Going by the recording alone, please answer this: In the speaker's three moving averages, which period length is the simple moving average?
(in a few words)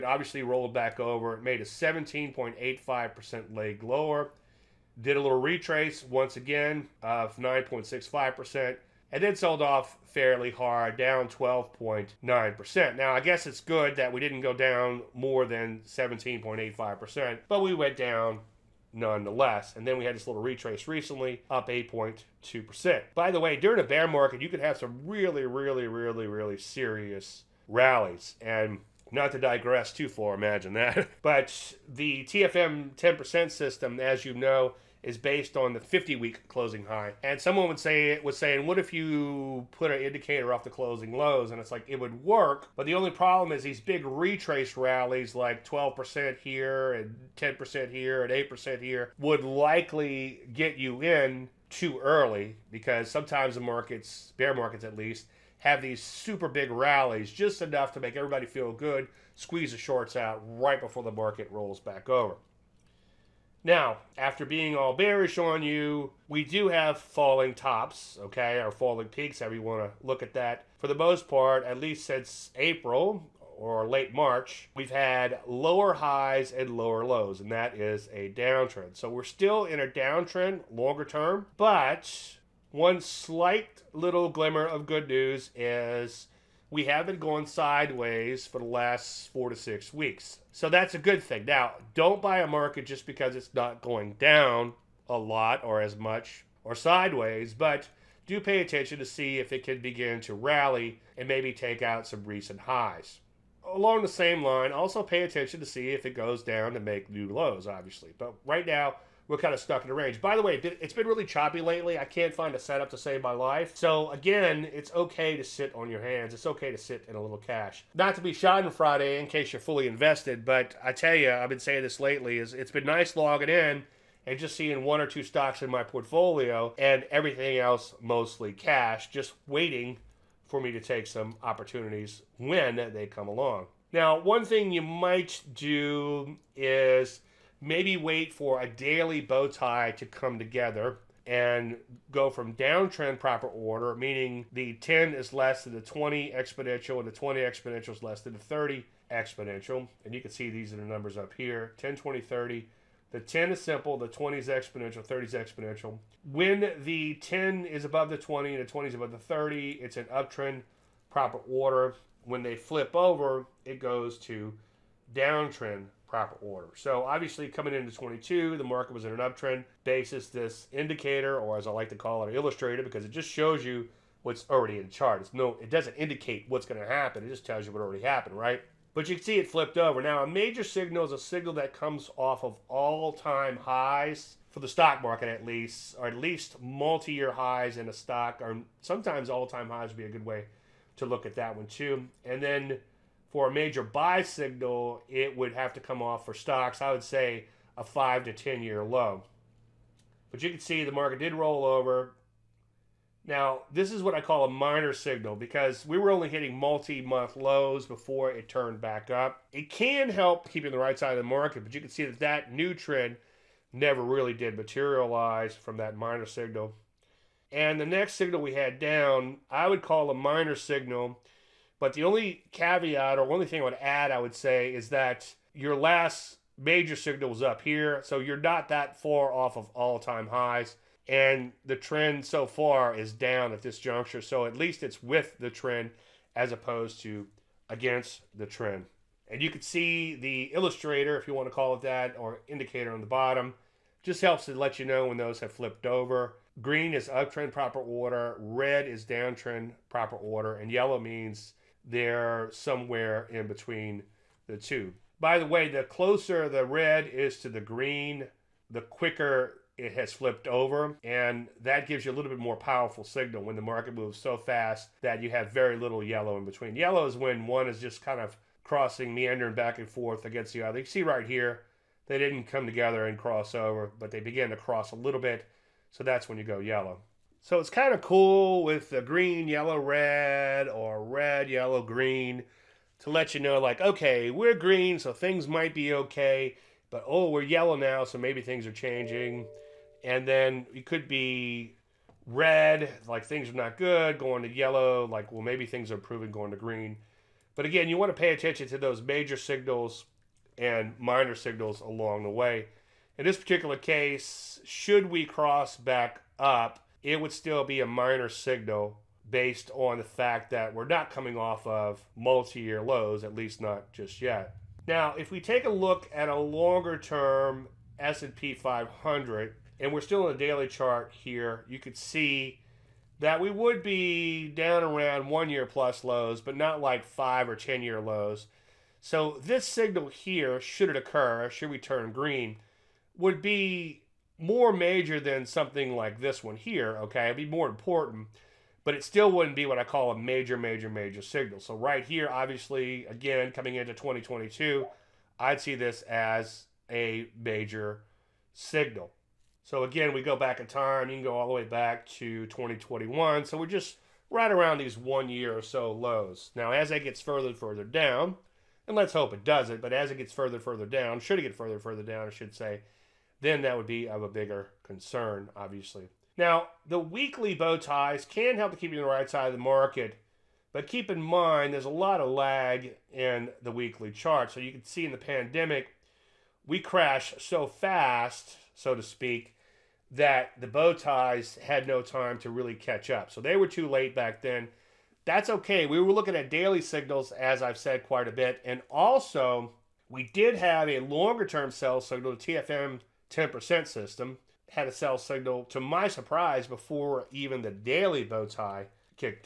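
10.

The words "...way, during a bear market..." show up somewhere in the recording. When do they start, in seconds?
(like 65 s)
23 s.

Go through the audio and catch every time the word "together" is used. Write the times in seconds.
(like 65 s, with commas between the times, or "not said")
140 s, 272 s.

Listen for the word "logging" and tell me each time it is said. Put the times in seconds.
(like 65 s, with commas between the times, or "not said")
123 s.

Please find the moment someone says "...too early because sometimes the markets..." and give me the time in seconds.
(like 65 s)
51 s.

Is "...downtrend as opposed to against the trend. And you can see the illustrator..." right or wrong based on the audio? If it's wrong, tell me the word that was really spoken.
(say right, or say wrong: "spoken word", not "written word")
wrong: "trend", not "downtrend".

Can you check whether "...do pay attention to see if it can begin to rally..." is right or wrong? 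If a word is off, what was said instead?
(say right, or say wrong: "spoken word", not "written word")
right.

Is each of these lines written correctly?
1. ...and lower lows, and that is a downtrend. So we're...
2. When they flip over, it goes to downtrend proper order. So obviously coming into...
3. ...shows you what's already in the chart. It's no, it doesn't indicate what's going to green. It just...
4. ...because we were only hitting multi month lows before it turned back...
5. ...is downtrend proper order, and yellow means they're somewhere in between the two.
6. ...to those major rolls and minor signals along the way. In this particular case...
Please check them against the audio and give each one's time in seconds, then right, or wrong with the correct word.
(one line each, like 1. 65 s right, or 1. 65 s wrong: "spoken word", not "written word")
1. 76 s right
2. 162 s right
3. 173 s wrong: "happen", not "green"
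4. 205 s right
5. 248 s right
6. 298 s wrong: "signals", not "rolls".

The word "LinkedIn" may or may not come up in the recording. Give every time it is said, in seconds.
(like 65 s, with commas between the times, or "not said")
not said.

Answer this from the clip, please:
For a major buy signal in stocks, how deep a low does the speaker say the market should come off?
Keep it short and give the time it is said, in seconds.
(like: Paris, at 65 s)
5 to 10 year low, at 197 s.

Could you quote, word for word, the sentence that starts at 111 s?
I can't find a setup to save my life.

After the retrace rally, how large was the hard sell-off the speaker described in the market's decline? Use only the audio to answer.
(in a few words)
12.9%.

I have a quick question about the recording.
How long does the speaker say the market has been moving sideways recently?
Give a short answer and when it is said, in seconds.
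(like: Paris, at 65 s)
four to six weeks, at 89 s.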